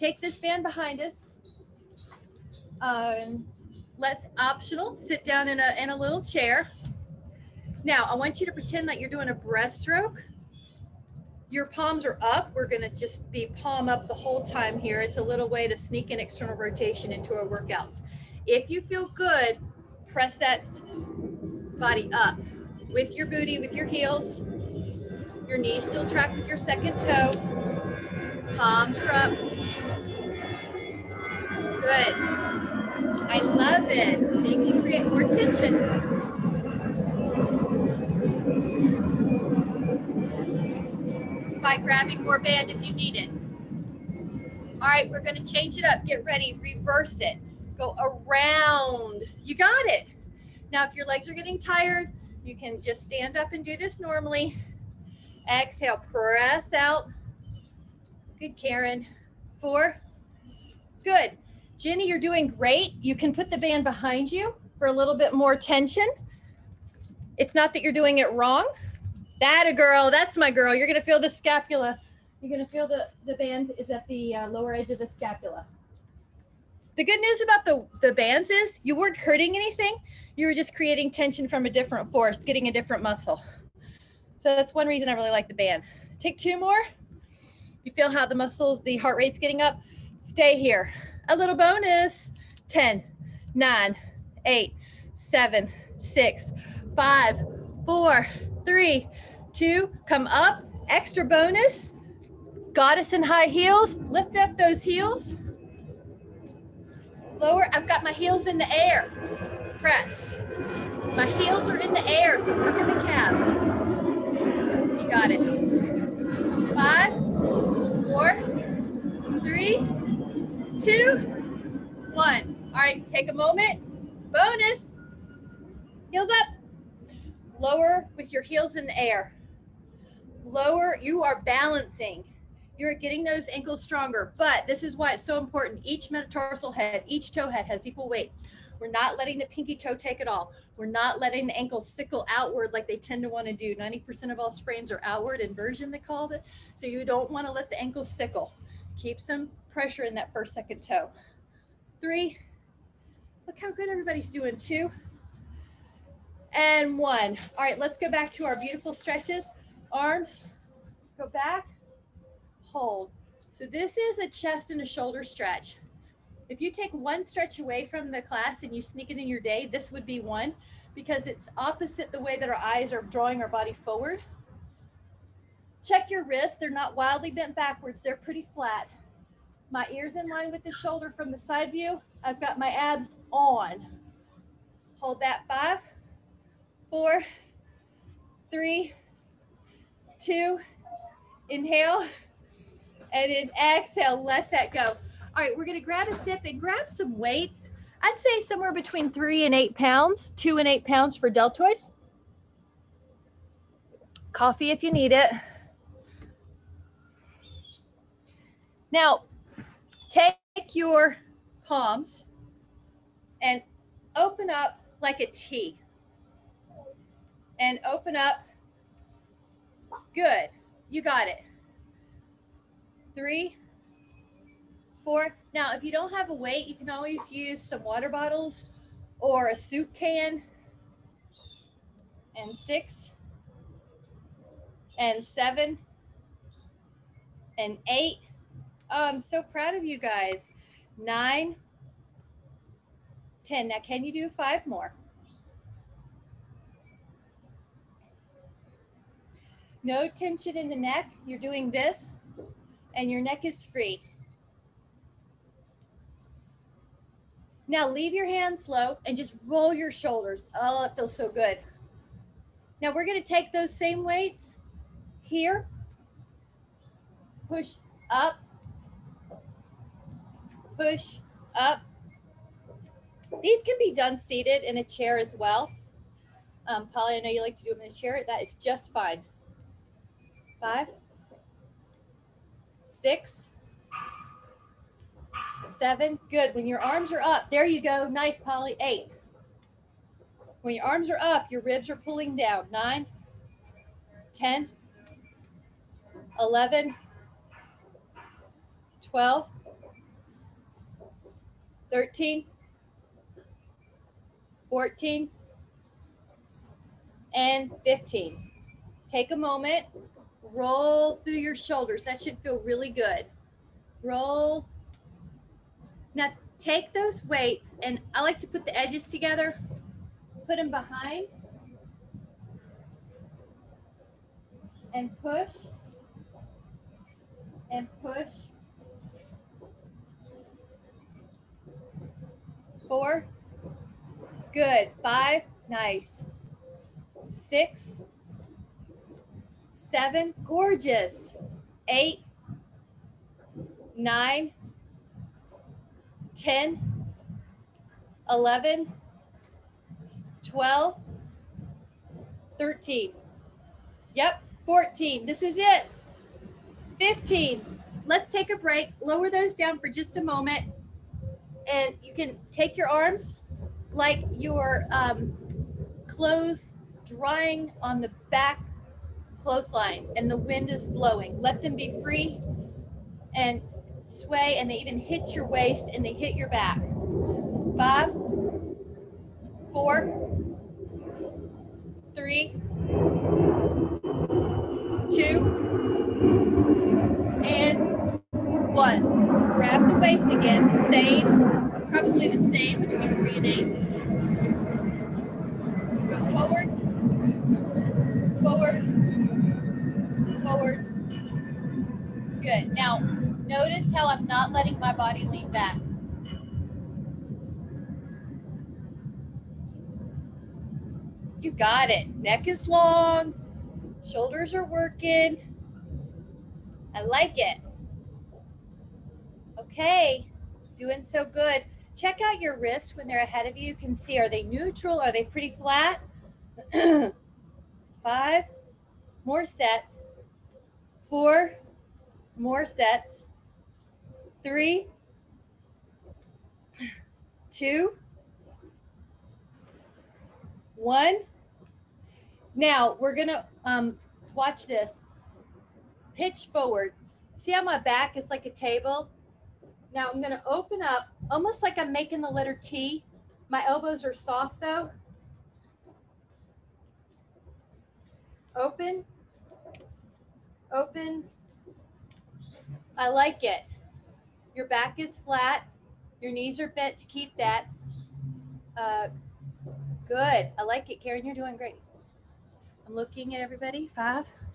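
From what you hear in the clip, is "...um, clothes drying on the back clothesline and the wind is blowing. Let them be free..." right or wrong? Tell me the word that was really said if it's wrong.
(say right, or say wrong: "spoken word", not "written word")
right.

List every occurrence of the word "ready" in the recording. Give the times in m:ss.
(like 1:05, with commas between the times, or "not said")
0:46.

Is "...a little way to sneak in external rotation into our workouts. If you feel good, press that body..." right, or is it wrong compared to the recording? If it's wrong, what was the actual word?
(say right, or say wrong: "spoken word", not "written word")
right.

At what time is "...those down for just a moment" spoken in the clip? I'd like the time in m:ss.
5:59.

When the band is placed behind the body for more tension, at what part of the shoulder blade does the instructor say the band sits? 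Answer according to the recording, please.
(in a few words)
Lower edge of the scapula.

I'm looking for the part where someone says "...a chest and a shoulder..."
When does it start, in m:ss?
2:44.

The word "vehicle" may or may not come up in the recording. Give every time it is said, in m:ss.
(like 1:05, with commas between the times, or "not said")
not said.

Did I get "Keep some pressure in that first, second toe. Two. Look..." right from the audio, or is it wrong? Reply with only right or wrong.
wrong.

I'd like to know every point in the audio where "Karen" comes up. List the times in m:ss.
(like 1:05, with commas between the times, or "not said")
0:58, 7:51.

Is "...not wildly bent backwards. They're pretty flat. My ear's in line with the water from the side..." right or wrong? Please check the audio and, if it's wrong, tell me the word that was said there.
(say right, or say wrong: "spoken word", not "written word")
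wrong: "shoulder", not "water".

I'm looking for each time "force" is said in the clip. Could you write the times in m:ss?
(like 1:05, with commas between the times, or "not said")
1:22.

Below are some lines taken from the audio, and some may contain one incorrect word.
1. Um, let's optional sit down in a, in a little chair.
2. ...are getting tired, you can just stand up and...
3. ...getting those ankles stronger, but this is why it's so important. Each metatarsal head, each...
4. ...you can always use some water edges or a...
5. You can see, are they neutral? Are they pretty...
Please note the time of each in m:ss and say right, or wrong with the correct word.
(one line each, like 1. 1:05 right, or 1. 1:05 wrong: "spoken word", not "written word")
1. 0:02 right
2. 0:51 right
3. 2:12 right
4. 3:46 wrong: "bottles", not "edges"
5. 7:03 right.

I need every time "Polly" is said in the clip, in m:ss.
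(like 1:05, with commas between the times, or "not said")
4:36, 4:48.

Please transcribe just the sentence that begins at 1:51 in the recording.
My heels are in the air, so working the calves.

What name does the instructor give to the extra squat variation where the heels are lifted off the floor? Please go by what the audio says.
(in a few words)
Goddess in high heels.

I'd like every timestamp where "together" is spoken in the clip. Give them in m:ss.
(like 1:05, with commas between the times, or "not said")
5:19.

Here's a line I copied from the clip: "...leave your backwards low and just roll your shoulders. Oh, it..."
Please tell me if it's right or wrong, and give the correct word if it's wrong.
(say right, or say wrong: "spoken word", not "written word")
wrong: "hands", not "backwards".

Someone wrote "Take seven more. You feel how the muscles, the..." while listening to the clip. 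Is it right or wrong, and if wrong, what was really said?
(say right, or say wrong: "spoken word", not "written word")
wrong: "two", not "seven".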